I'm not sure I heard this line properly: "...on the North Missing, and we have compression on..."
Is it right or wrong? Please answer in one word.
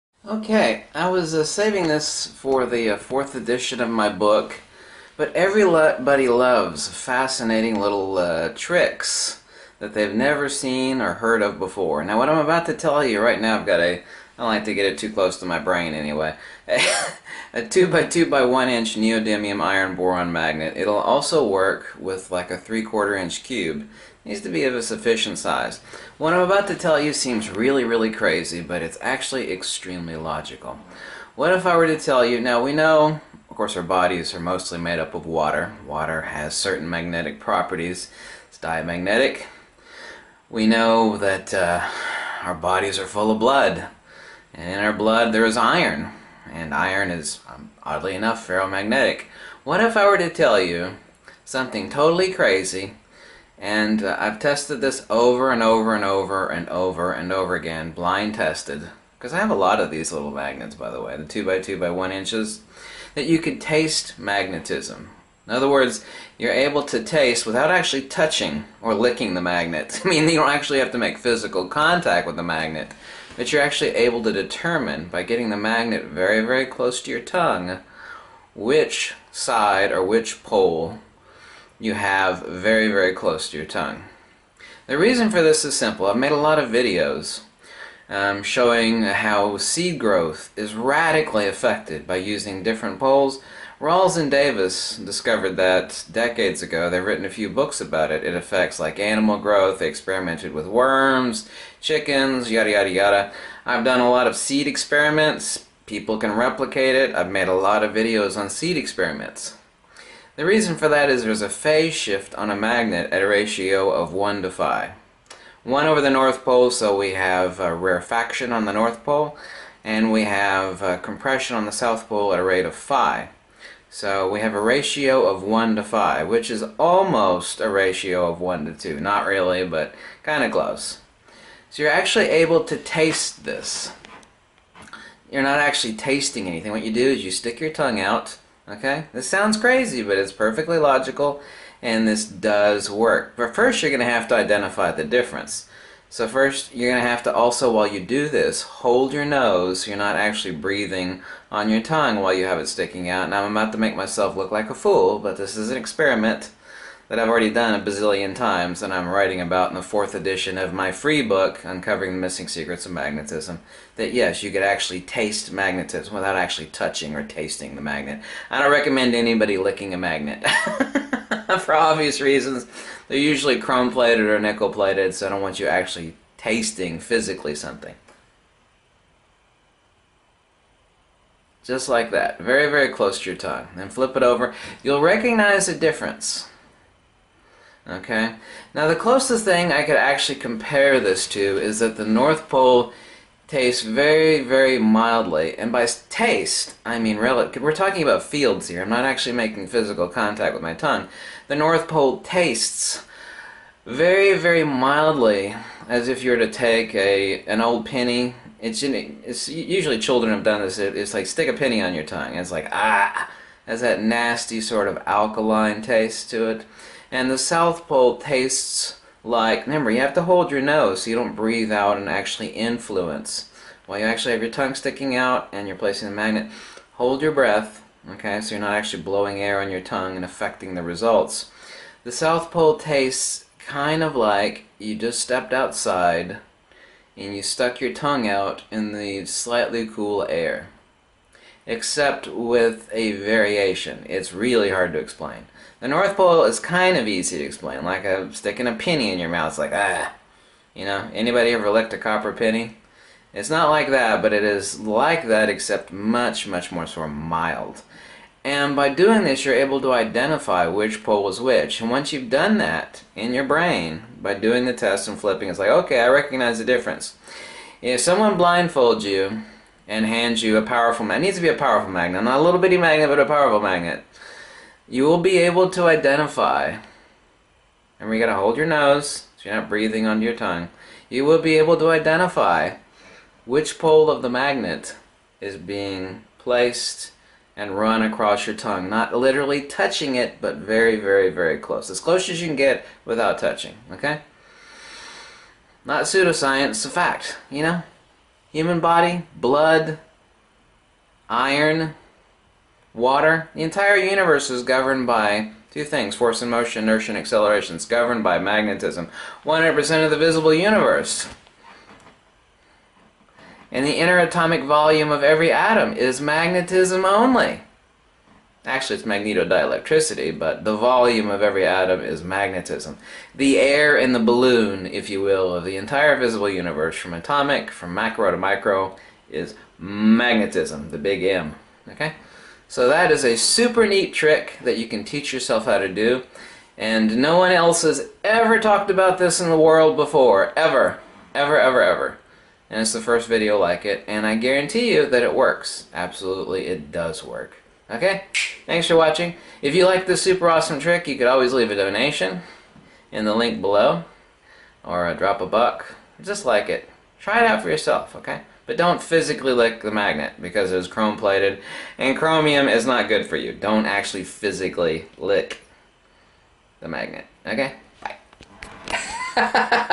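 wrong.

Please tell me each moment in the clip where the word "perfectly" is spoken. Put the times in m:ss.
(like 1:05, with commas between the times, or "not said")
2:20.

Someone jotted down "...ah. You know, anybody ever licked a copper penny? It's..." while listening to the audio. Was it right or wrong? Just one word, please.
right.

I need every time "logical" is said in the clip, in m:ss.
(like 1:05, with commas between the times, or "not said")
0:30, 2:20.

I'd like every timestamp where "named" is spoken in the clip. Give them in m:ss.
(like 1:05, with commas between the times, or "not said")
not said.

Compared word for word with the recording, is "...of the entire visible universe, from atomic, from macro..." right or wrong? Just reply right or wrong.
right.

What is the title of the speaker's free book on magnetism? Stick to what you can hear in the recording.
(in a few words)
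Uncovering the Missing Secrets of Magnetism.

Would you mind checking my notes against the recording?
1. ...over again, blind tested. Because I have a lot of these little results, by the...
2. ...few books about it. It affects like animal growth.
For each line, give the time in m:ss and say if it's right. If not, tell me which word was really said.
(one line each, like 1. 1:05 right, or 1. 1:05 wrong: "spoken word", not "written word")
1. 0:57 wrong: "magnets", not "results"
2. 1:37 right.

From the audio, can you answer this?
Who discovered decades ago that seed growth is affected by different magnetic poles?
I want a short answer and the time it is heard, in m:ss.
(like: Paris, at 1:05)
Rawls and Davis, at 1:33.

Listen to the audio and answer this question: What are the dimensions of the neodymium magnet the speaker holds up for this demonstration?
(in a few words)
2 by 2 by 1 inch.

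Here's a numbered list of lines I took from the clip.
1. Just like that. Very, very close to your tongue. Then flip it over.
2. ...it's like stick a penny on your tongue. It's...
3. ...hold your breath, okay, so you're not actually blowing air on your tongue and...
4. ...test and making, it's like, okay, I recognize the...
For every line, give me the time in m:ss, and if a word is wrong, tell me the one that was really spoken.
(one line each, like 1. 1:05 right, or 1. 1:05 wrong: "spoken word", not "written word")
1. 3:01 right
2. 3:30 right
3. 3:46 right
4. 4:24 wrong: "flipping", not "making".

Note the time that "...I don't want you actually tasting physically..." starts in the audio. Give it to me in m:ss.
2:55.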